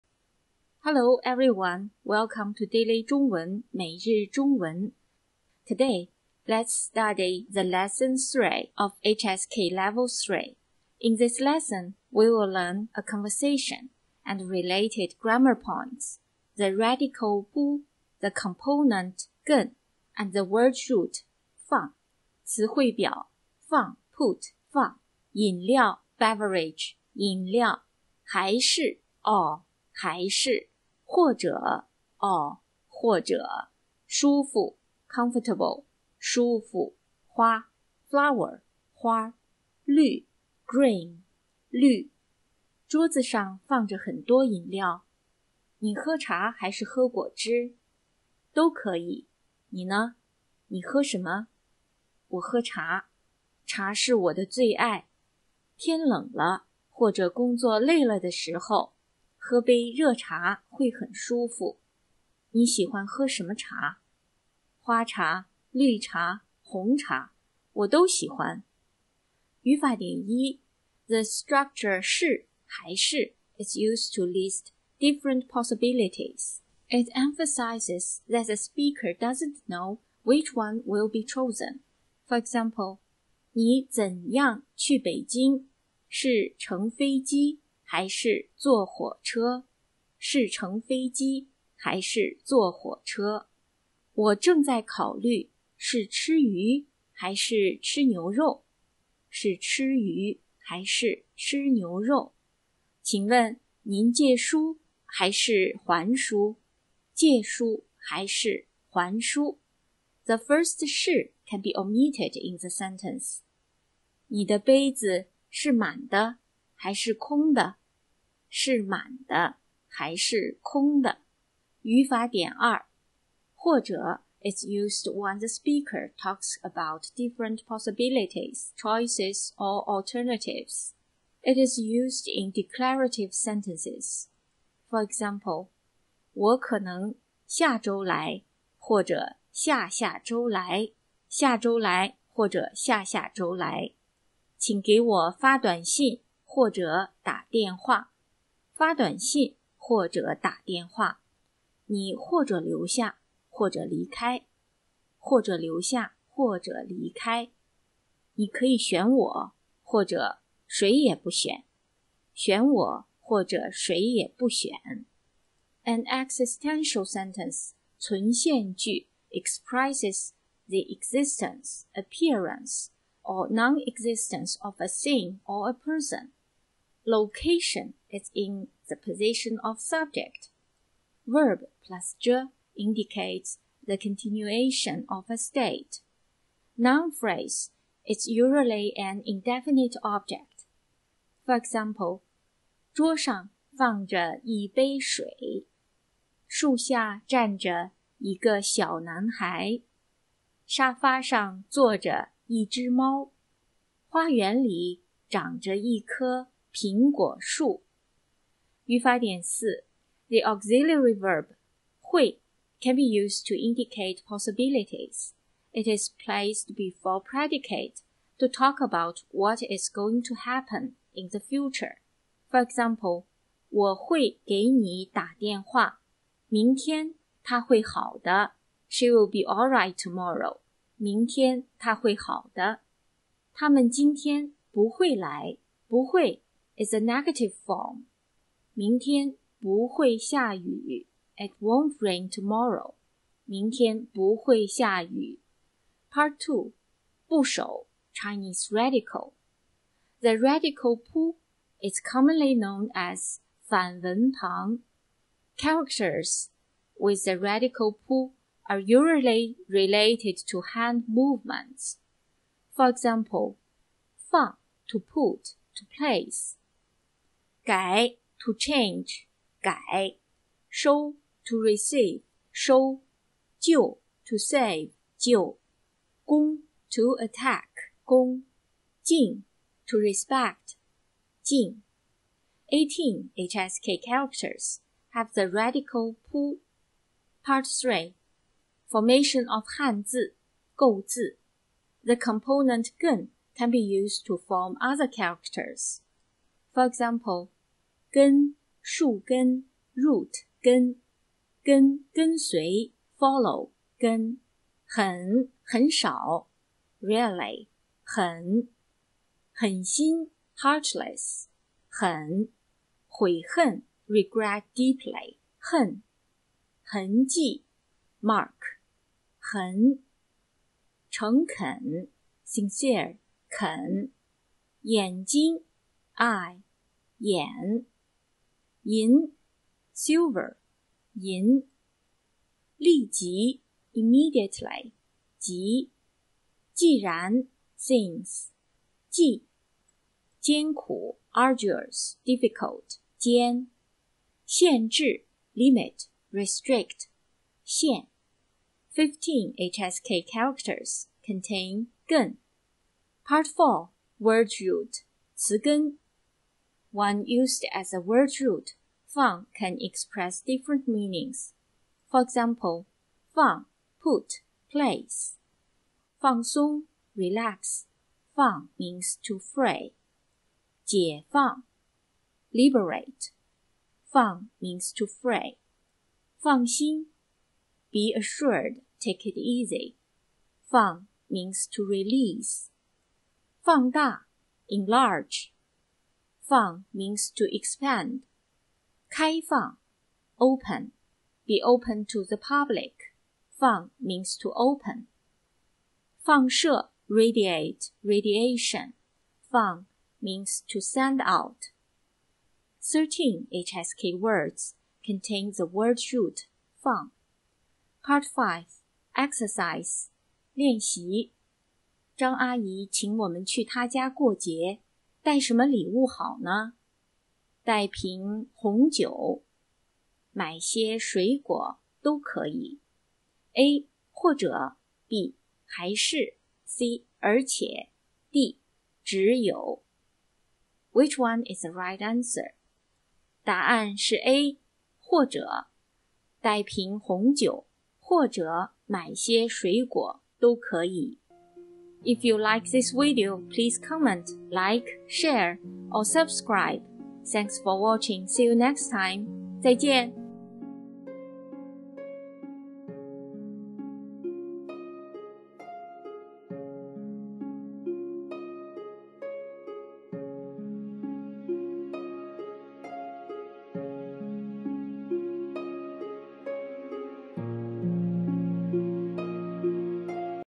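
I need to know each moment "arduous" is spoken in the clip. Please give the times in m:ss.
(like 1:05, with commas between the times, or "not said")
5:41.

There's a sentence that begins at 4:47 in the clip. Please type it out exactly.
Part 3 Formation of Hanzi, Gouzi.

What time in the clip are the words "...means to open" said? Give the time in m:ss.
6:34.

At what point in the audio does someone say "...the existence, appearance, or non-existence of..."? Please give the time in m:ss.
2:50.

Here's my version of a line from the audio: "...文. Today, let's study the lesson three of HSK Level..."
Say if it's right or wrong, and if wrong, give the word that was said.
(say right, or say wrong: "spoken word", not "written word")
right.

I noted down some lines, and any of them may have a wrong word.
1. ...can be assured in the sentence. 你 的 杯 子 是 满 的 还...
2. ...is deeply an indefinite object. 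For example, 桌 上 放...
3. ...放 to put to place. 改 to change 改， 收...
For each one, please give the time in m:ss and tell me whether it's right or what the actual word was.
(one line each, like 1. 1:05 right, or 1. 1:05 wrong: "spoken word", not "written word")
1. 1:51 wrong: "omitted", not "assured"
2. 3:08 wrong: "usually", not "deeply"
3. 4:24 right.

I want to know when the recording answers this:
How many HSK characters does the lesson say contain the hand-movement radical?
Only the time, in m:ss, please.
4:42.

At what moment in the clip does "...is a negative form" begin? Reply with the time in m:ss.
3:56.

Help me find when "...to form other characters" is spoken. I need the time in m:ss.
4:54.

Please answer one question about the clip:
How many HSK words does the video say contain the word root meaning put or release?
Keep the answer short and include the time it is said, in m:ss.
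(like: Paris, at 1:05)
13, at 6:42.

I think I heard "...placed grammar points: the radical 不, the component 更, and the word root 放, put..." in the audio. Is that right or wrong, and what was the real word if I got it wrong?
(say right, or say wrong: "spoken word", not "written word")
wrong: "related", not "placed".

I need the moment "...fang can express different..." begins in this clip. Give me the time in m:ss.
5:59.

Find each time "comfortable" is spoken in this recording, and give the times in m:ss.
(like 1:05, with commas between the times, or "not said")
0:35.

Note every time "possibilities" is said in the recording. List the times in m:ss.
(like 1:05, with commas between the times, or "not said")
1:15, 2:07, 3:34.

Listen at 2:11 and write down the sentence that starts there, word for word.
It is used in declarative sentences.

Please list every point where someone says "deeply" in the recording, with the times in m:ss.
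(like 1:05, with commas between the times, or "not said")
5:14.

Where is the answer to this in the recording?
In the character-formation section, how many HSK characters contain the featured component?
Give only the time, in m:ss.
5:48.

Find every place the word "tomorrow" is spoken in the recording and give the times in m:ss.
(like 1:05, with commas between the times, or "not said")
3:49, 4:02.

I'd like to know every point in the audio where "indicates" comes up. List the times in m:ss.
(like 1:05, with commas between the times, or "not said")
3:02, 3:33.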